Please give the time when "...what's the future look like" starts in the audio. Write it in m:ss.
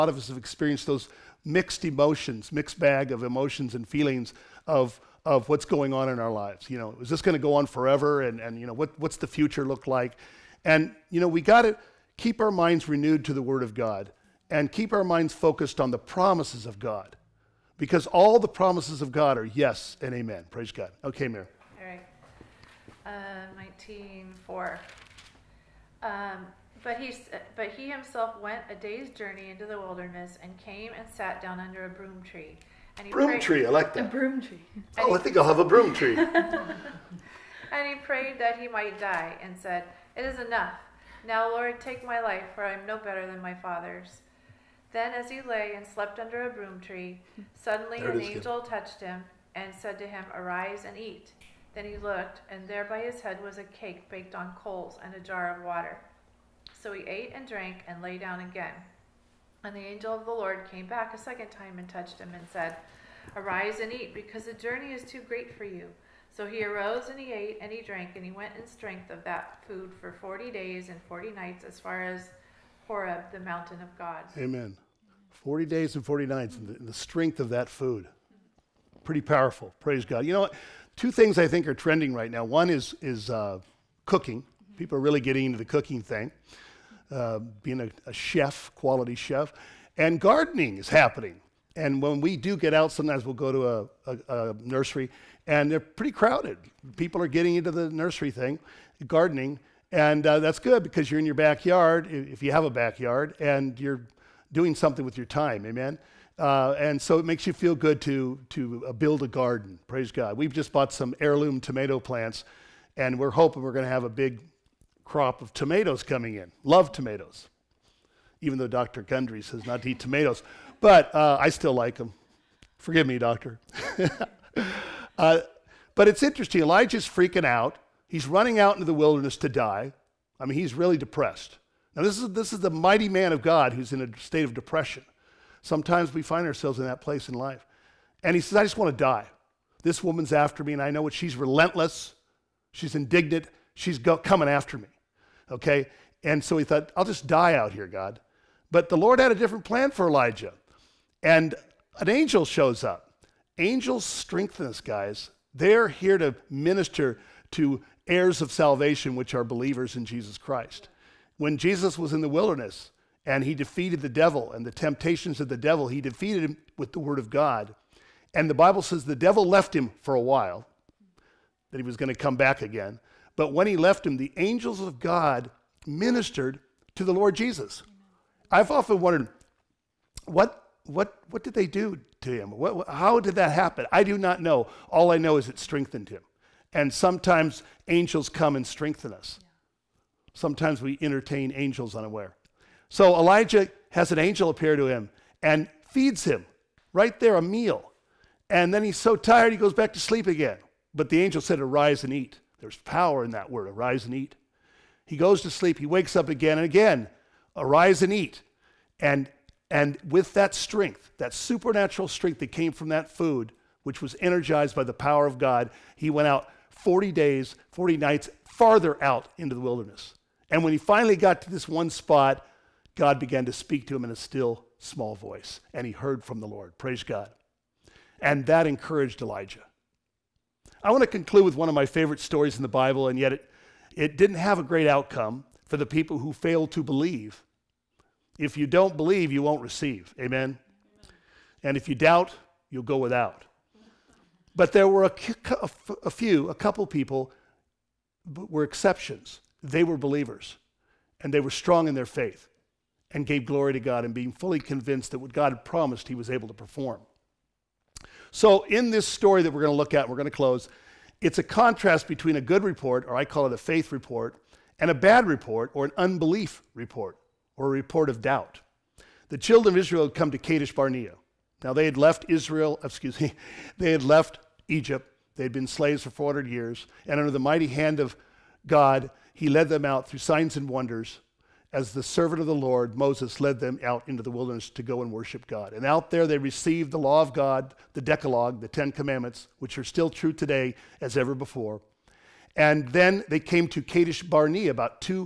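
0:08.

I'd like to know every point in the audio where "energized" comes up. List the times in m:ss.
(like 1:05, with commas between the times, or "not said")
3:34.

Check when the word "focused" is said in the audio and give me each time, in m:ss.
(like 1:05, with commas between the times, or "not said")
0:15.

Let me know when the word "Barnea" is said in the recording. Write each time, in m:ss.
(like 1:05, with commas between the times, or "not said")
4:30, 4:54.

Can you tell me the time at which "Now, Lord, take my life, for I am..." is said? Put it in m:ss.
0:41.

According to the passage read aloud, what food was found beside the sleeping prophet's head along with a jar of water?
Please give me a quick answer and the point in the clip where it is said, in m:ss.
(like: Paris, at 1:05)
A cake baked on coals, at 0:53.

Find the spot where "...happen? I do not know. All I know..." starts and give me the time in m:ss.
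3:03.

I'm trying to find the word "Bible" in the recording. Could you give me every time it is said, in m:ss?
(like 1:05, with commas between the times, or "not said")
2:48, 3:52.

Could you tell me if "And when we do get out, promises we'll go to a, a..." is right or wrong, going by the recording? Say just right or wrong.
wrong.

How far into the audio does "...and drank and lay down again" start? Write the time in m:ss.
0:57.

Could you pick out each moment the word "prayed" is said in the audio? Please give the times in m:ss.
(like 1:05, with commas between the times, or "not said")
0:33, 0:38.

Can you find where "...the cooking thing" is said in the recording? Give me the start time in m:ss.
1:25.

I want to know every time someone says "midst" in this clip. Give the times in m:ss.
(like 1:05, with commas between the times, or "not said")
not said.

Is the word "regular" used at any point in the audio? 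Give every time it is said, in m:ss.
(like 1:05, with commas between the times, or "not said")
not said.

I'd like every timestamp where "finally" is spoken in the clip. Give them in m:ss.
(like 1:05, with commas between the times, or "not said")
3:40.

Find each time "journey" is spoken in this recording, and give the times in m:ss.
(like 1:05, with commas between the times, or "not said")
0:29, 1:04.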